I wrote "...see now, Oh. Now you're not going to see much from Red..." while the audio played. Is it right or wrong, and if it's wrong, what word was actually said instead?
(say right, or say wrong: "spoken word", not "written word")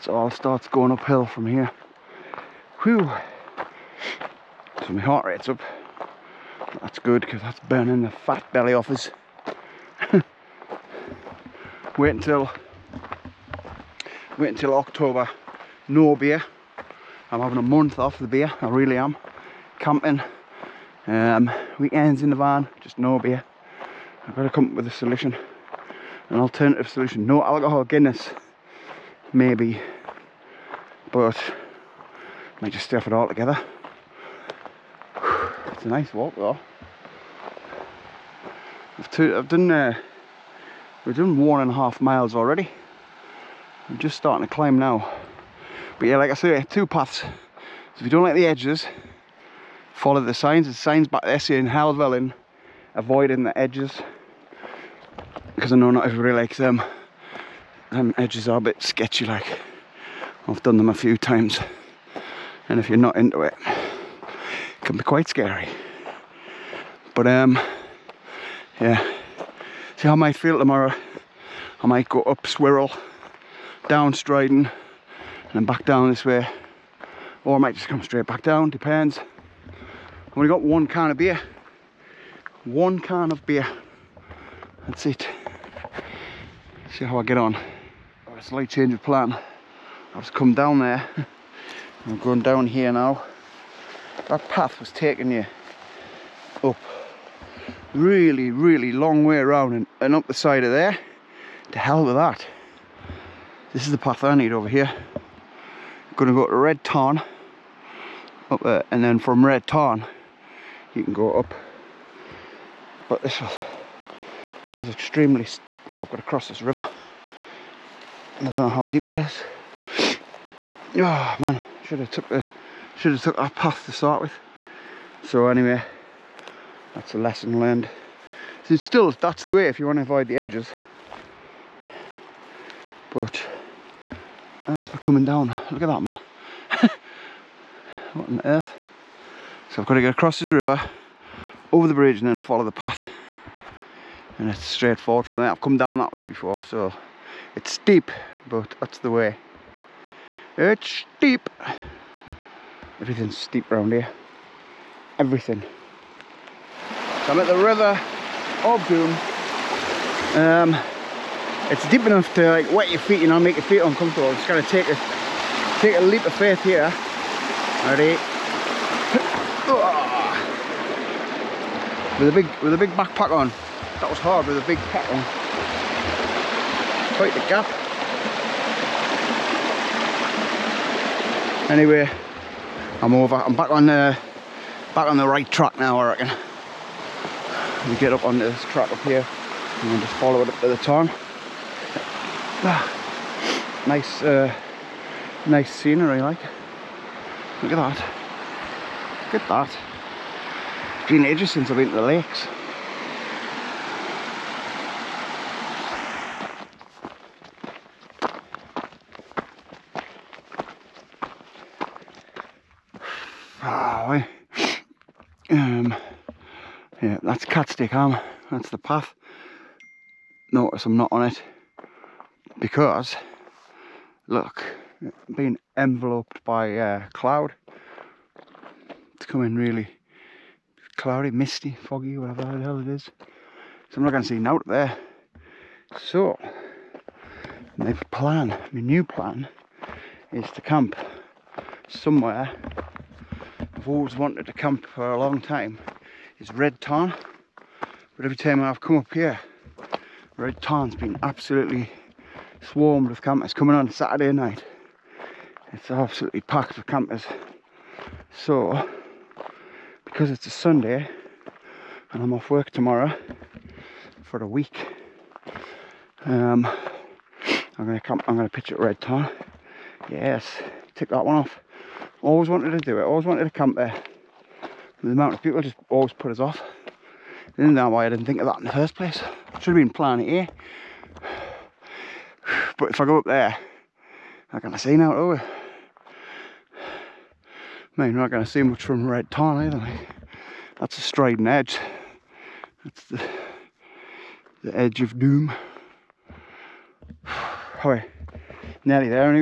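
right.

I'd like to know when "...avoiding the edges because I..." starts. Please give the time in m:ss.
0:52.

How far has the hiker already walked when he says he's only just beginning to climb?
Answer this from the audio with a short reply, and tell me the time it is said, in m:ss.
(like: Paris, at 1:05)
1.5 miles, at 0:41.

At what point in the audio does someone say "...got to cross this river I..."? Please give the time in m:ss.
1:56.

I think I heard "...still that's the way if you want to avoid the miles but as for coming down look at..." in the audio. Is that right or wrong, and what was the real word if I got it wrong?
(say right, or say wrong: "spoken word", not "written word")
wrong: "edges", not "miles".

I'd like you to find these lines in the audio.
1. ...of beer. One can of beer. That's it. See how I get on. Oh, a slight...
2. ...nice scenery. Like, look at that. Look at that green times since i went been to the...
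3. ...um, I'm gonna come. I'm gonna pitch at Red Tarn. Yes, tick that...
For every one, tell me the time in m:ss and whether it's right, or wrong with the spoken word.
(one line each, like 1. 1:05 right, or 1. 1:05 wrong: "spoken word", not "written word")
1. 1:21 right
2. 3:15 wrong: "edges", not "times"
3. 4:26 right.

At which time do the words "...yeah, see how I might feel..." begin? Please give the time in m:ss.
1:08.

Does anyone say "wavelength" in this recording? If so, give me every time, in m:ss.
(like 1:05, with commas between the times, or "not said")
not said.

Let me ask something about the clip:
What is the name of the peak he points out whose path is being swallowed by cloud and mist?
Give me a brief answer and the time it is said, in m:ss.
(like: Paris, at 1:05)
Catstye Cam, at 3:37.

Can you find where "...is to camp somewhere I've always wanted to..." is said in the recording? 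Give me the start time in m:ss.
4:00.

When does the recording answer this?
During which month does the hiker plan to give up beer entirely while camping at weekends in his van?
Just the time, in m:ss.
0:14.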